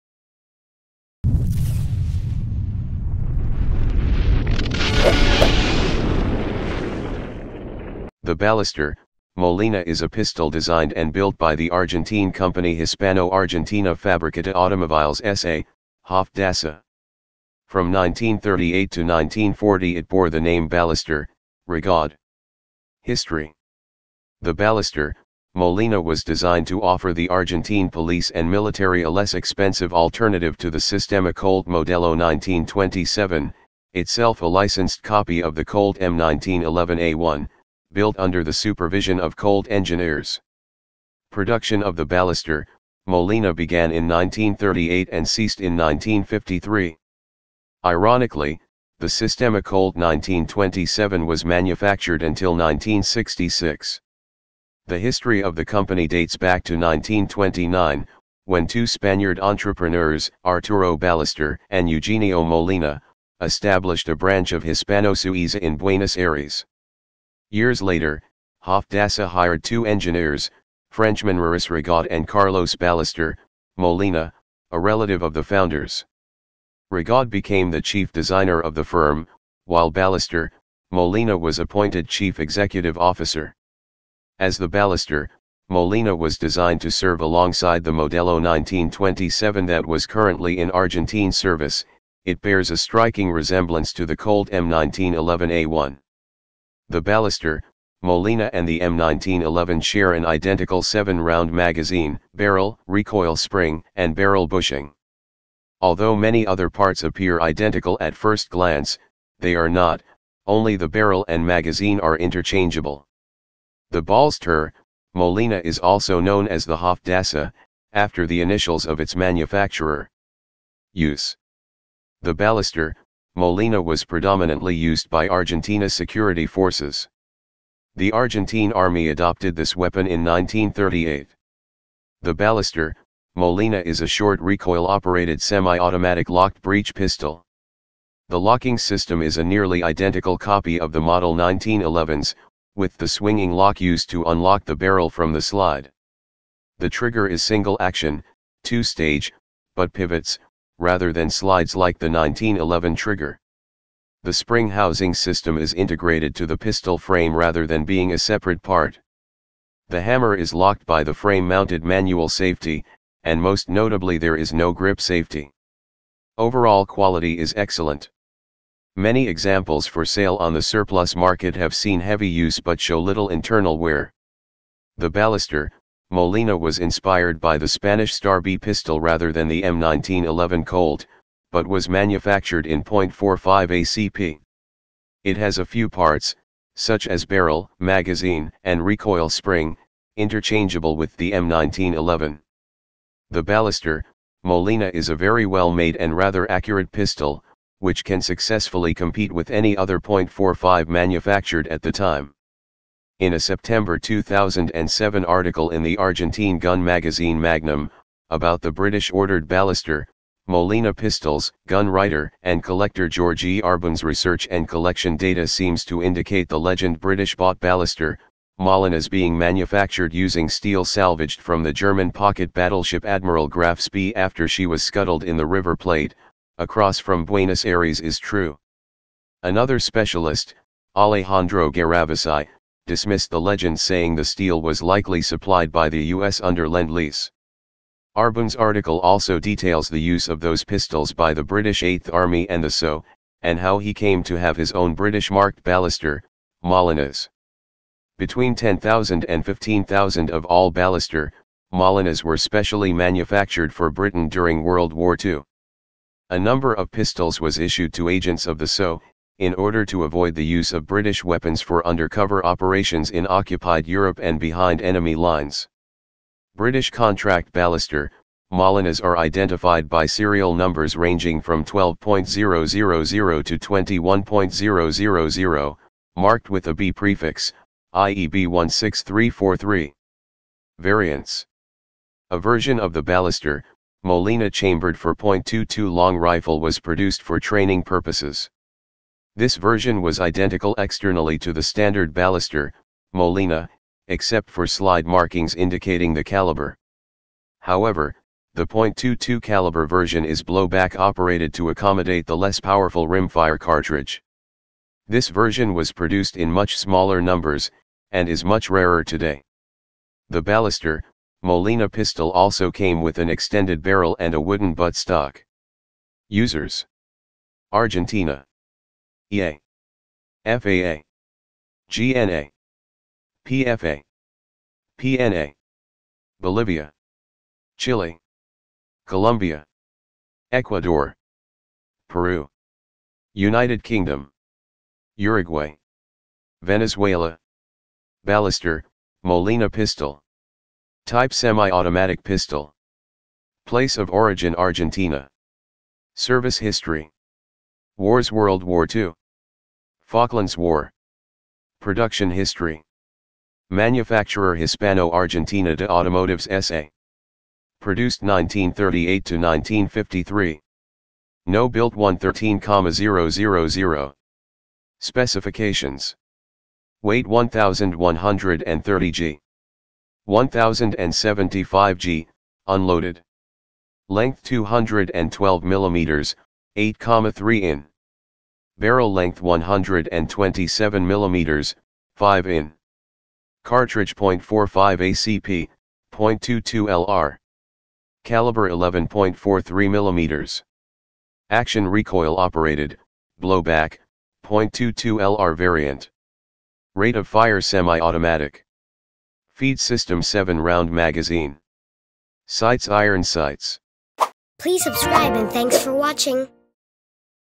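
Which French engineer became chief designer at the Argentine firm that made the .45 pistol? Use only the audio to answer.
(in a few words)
Maurice Rigaud.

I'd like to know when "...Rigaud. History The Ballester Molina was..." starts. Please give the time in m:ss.
0:21.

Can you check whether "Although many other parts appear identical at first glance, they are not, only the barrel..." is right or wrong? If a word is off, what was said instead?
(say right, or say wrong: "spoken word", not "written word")
right.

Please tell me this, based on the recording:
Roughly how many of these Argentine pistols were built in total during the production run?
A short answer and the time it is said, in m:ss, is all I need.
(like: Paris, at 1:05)
113,000, at 6:01.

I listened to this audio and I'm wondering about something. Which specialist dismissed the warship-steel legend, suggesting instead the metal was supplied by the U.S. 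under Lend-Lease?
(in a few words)
Alejandro Garavasai.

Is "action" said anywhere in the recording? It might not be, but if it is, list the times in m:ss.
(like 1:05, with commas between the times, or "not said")
2:27, 6:31.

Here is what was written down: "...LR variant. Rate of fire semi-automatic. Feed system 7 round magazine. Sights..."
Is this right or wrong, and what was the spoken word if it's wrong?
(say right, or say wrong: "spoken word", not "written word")
right.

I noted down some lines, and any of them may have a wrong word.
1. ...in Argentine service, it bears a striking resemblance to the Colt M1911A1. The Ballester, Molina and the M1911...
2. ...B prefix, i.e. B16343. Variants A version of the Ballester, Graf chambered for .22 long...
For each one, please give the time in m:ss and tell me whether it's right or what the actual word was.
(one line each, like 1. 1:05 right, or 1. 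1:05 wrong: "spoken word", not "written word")
1. 1:30 right
2. 4:36 wrong: "Molina", not "Graf".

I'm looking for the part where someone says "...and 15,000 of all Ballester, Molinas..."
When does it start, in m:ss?
4:09.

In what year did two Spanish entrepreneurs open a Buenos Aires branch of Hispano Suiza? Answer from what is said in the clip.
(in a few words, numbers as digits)
1929.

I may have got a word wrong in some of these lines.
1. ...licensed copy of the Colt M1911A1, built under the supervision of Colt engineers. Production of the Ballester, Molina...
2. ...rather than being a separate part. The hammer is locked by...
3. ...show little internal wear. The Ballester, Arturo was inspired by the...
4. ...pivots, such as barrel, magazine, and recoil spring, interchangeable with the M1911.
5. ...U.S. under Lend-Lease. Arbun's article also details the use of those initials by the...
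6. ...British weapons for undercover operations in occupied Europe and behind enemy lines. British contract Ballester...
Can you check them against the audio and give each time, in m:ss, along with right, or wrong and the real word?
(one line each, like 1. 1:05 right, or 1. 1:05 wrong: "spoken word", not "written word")
1. 0:34 right
2. 2:37 right
3. 2:52 wrong: "Molina", not "Arturo"
4. 3:05 wrong: "parts", not "pivots"
5. 3:56 wrong: "pistols", not "initials"
6. 4:20 right.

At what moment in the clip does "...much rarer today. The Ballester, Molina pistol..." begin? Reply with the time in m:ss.
5:08.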